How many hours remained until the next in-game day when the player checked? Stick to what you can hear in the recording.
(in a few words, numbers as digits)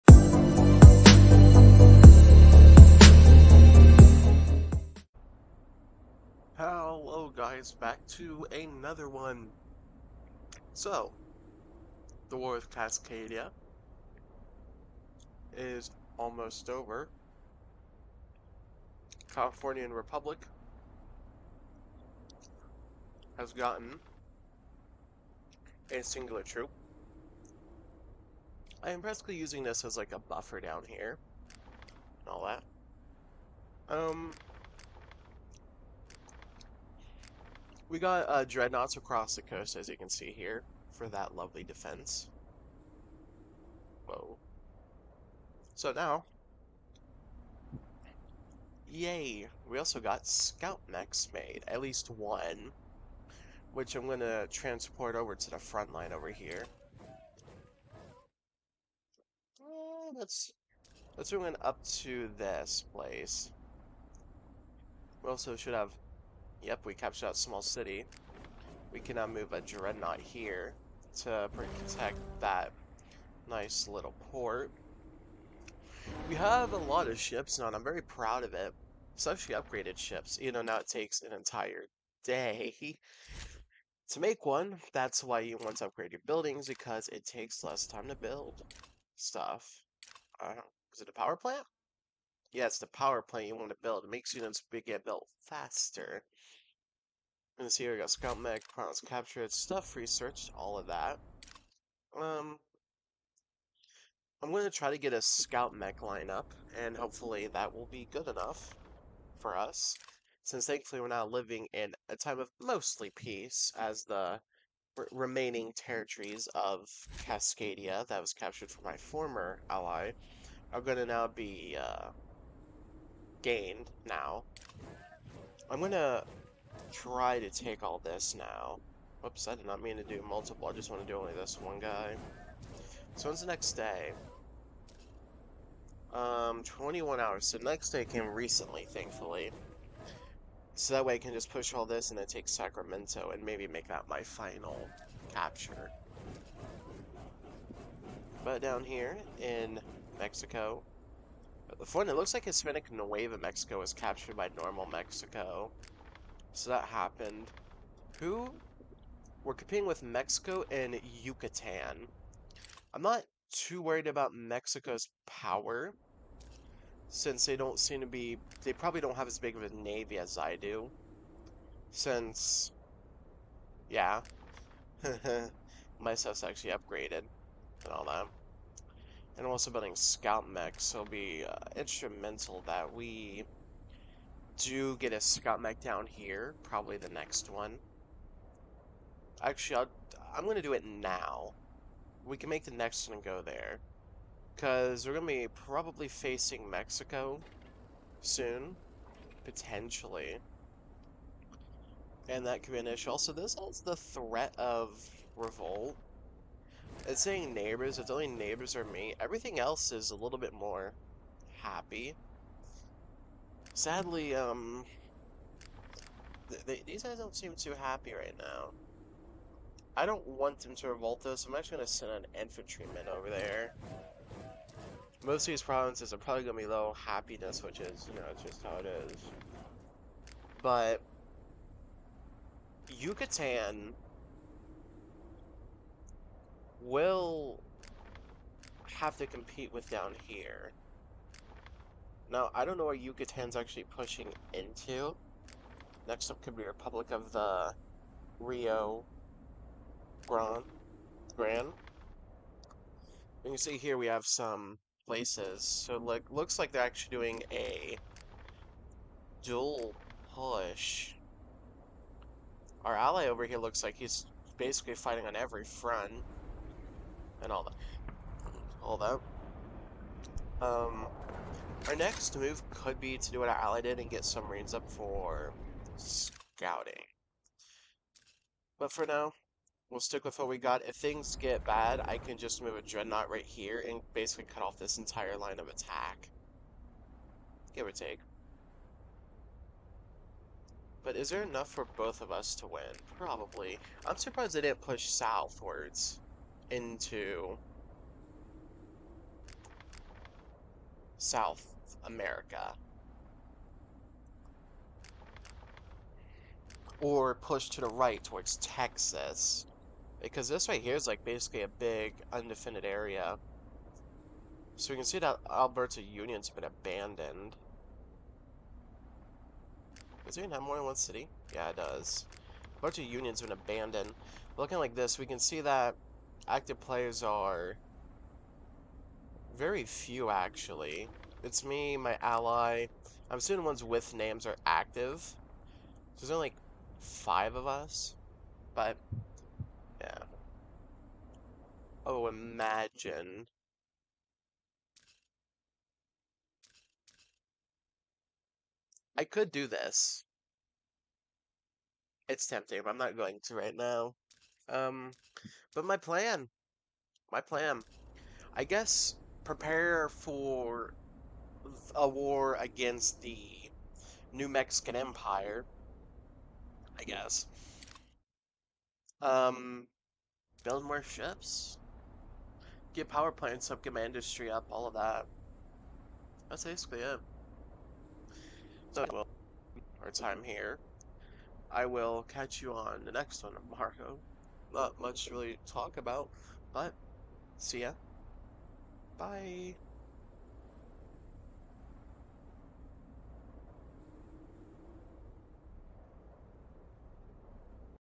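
21.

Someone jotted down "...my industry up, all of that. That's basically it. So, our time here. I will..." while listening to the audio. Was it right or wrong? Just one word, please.
right.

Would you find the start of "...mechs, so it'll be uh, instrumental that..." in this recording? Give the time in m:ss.
3:00.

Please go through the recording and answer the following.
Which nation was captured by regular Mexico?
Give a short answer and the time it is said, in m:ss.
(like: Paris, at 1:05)
Hispanic Nueva Mexico, at 2:32.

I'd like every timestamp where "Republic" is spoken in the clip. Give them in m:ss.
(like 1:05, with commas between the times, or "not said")
0:19, 4:06.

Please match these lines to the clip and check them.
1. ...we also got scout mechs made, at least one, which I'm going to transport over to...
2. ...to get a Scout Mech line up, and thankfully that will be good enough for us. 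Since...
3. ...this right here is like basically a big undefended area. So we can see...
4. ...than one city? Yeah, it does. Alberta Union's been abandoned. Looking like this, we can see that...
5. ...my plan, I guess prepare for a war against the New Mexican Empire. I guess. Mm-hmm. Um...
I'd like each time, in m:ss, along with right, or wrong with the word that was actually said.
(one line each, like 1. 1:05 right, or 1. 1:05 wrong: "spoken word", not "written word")
1. 0:49 right
2. 1:44 wrong: "hopefully", not "thankfully"
3. 5:10 right
4. 5:20 right
5. 5:57 right.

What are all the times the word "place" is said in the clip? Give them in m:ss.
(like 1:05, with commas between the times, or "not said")
1:02, 4:15.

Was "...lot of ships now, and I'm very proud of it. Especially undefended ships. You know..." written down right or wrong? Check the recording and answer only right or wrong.
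wrong.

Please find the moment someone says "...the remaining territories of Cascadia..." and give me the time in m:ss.
1:54.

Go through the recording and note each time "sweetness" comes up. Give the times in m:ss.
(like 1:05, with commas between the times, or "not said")
not said.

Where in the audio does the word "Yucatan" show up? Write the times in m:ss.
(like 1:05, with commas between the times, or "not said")
2:41, 3:52, 4:02.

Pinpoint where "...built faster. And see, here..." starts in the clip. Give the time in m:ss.
1:35.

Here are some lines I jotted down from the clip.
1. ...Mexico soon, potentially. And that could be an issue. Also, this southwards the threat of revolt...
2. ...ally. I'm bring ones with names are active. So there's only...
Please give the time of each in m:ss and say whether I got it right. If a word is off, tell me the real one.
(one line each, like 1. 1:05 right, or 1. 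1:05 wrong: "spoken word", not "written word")
1. 3:16 wrong: "holds", not "southwards"
2. 5:32 wrong: "assuming", not "bring".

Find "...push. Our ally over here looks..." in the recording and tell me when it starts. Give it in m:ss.
4:20.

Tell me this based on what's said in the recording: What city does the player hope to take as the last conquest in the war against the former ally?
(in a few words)
Sacramento.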